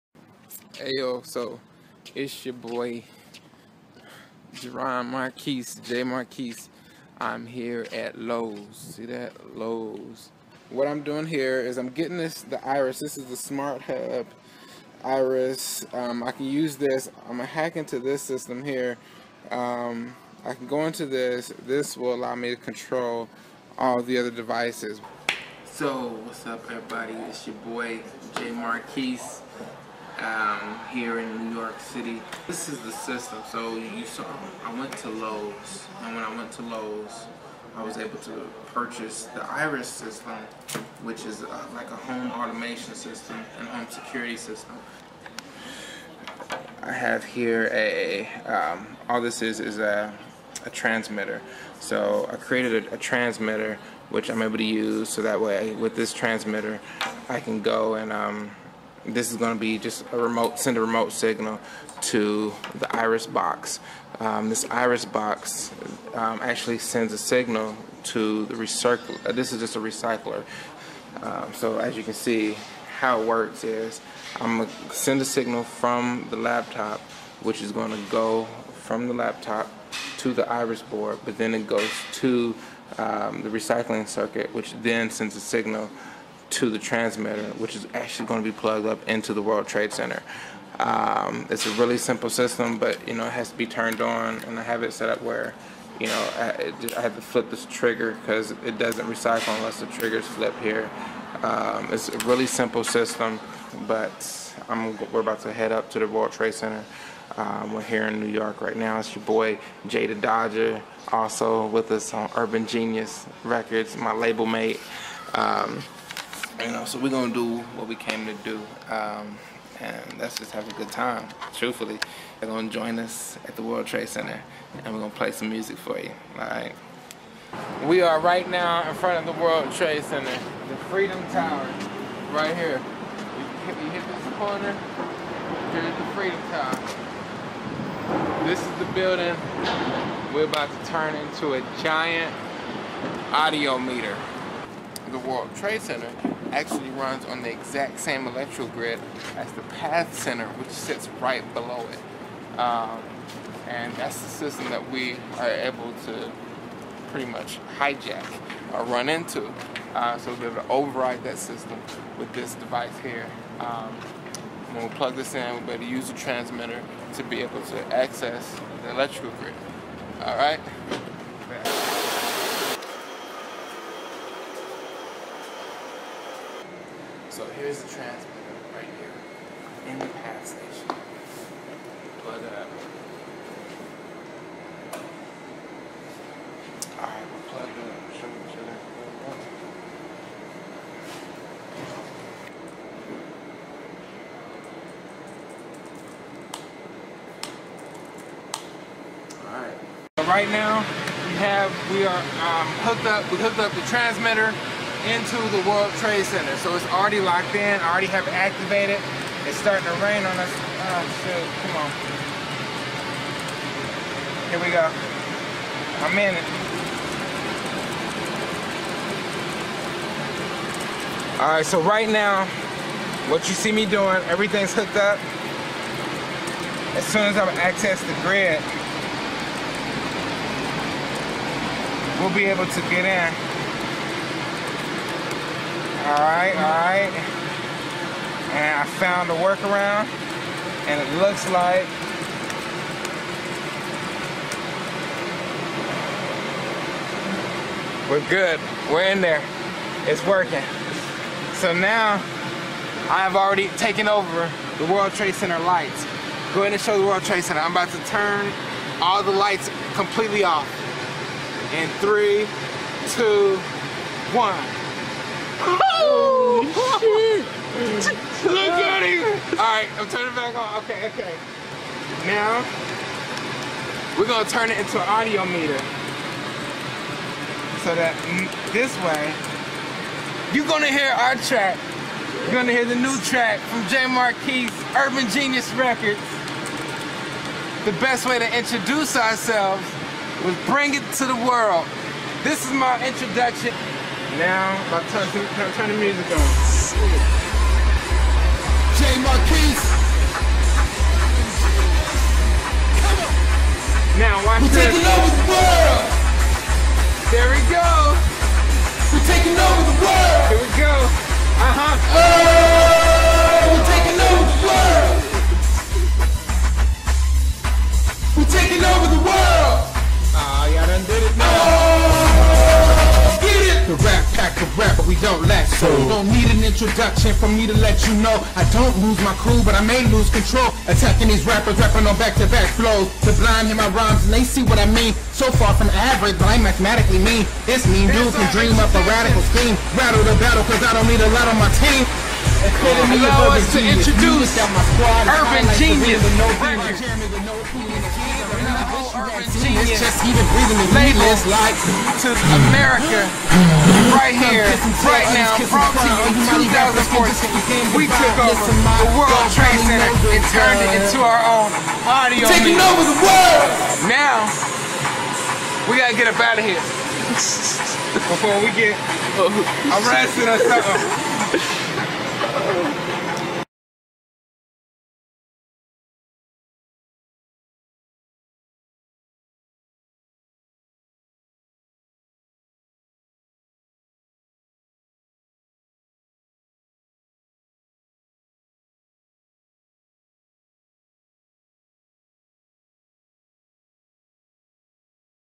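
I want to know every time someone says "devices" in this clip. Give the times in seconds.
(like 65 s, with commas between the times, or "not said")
24 s, 162 s.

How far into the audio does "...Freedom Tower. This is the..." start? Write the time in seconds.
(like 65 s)
136 s.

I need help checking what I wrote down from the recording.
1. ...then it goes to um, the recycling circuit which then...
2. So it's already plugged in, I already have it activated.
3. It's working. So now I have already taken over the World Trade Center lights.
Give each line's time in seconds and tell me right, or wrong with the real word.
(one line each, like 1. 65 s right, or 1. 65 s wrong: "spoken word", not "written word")
1. 81 s right
2. 206 s wrong: "locked", not "plugged"
3. 250 s right.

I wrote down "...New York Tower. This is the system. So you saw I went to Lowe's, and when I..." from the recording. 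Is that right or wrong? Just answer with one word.
wrong.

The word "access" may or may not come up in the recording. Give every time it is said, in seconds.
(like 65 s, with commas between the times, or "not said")
167 s, 227 s.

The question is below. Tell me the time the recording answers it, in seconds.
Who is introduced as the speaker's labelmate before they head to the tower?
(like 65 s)
109 s.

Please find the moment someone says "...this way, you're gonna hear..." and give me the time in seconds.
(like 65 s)
278 s.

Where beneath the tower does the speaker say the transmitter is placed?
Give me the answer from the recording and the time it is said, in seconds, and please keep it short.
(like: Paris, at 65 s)
PATH station, at 180 s.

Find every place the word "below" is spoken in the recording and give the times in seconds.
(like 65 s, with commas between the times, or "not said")
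151 s.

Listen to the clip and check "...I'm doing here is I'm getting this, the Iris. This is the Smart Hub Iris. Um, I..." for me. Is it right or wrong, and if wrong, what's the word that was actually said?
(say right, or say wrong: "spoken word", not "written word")
right.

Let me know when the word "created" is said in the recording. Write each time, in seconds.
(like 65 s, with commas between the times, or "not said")
52 s.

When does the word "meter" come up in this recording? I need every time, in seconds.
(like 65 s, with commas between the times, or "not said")
143 s, 275 s.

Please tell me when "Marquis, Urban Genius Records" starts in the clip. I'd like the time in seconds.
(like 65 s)
284 s.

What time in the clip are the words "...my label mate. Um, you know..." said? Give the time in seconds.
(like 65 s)
113 s.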